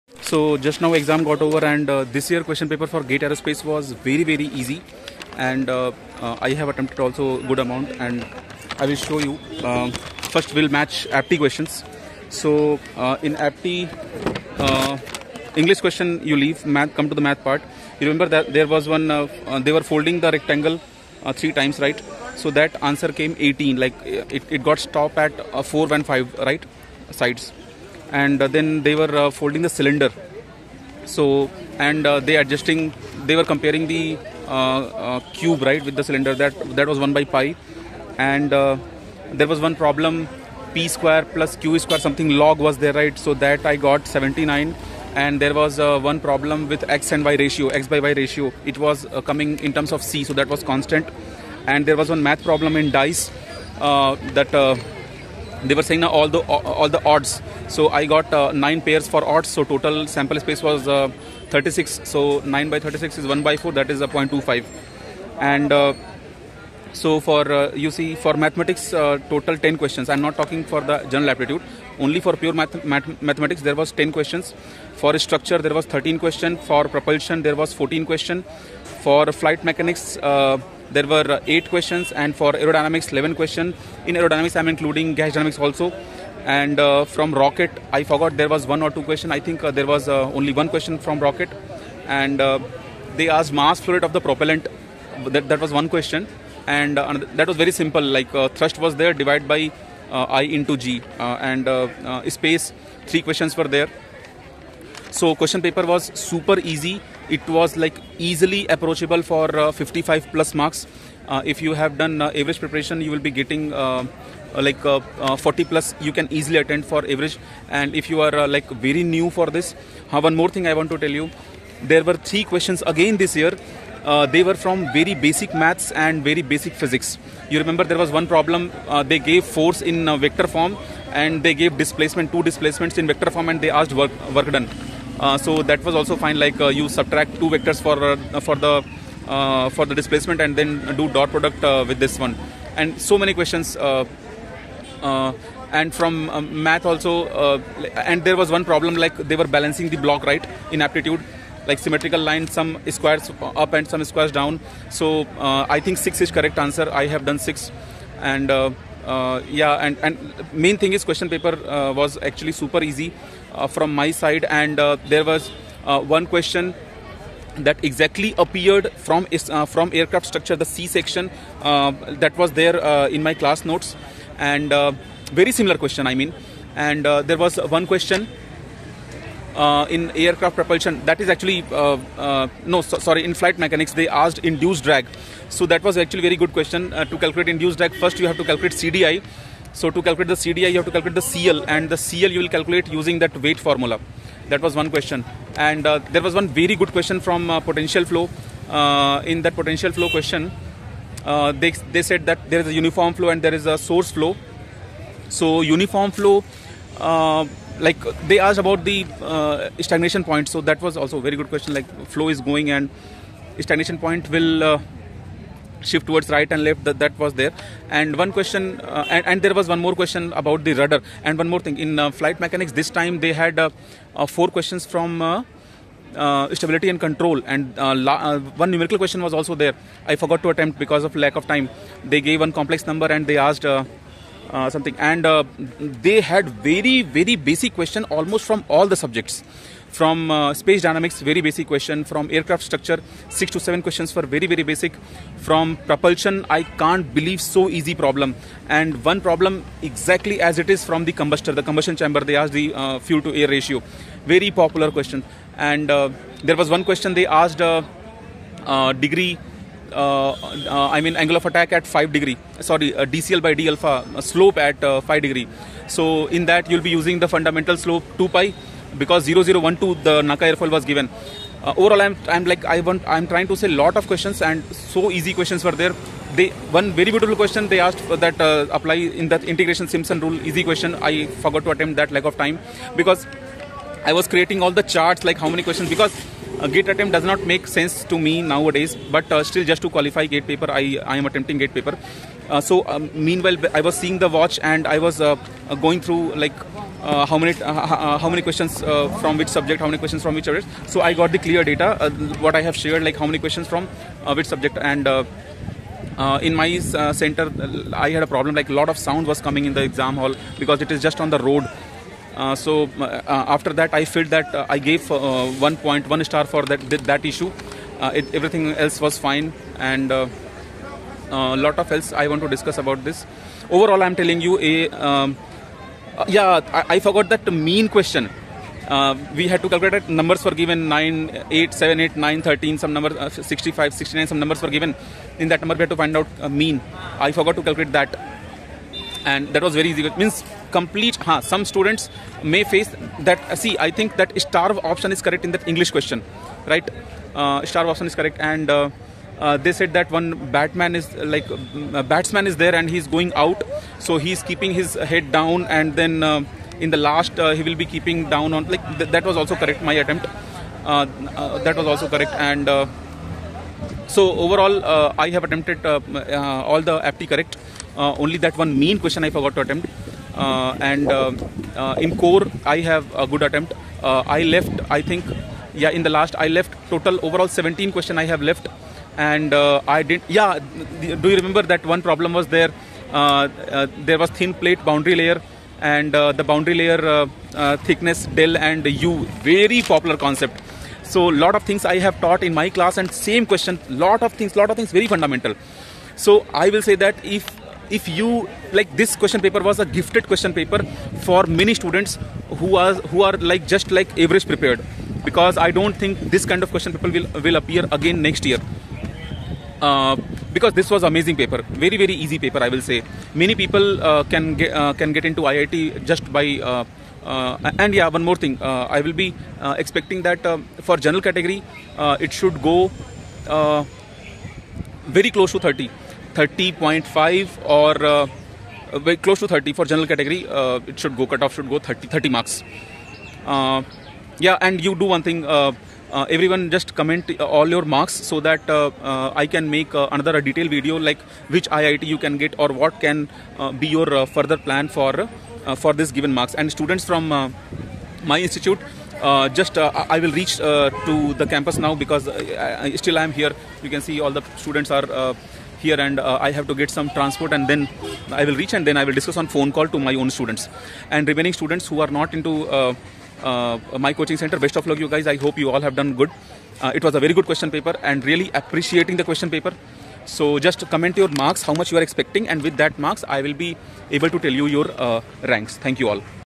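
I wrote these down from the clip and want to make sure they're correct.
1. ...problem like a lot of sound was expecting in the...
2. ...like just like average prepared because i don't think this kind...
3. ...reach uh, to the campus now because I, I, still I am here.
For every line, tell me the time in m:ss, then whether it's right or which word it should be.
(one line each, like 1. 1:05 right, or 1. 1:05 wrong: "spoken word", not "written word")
1. 5:08 wrong: "coming", not "expecting"
2. 6:43 right
3. 7:30 right.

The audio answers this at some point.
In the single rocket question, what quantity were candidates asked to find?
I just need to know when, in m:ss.
1:33.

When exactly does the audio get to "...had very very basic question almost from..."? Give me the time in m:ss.
3:56.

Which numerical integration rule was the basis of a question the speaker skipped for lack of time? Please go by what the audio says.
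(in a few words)
Simpson rule.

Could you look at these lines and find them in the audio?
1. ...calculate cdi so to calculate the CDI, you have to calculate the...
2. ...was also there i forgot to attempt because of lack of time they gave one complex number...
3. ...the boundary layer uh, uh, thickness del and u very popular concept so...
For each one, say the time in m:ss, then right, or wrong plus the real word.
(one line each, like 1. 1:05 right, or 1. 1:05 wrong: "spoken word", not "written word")
1. 3:08 right
2. 3:49 right
3. 6:26 right.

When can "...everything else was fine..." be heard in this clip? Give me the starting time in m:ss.
5:18.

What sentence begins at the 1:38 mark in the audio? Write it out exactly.
Like thrust was there divided by uh, I into G uh, and uh, space.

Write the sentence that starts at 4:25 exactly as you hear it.
So in that you'll be using the fundamental slope 2 pi because 0012 the NACA airfoil was given.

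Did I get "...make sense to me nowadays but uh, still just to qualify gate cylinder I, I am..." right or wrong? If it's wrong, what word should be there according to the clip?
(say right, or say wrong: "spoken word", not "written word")
wrong: "paper", not "cylinder".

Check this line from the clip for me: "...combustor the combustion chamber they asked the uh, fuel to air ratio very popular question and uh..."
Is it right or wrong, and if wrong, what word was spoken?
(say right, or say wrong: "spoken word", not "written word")
right.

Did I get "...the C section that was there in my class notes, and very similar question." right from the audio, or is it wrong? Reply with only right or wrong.
right.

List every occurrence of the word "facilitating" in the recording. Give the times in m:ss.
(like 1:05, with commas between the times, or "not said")
not said.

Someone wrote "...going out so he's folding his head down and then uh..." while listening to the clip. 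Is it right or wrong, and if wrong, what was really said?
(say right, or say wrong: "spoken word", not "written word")
wrong: "keeping", not "folding".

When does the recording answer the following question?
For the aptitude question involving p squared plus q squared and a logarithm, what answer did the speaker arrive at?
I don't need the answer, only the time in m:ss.
0:44.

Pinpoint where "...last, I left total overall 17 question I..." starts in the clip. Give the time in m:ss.
6:16.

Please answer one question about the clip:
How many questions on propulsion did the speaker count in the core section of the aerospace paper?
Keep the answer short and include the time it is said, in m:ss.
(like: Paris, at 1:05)
14, at 1:17.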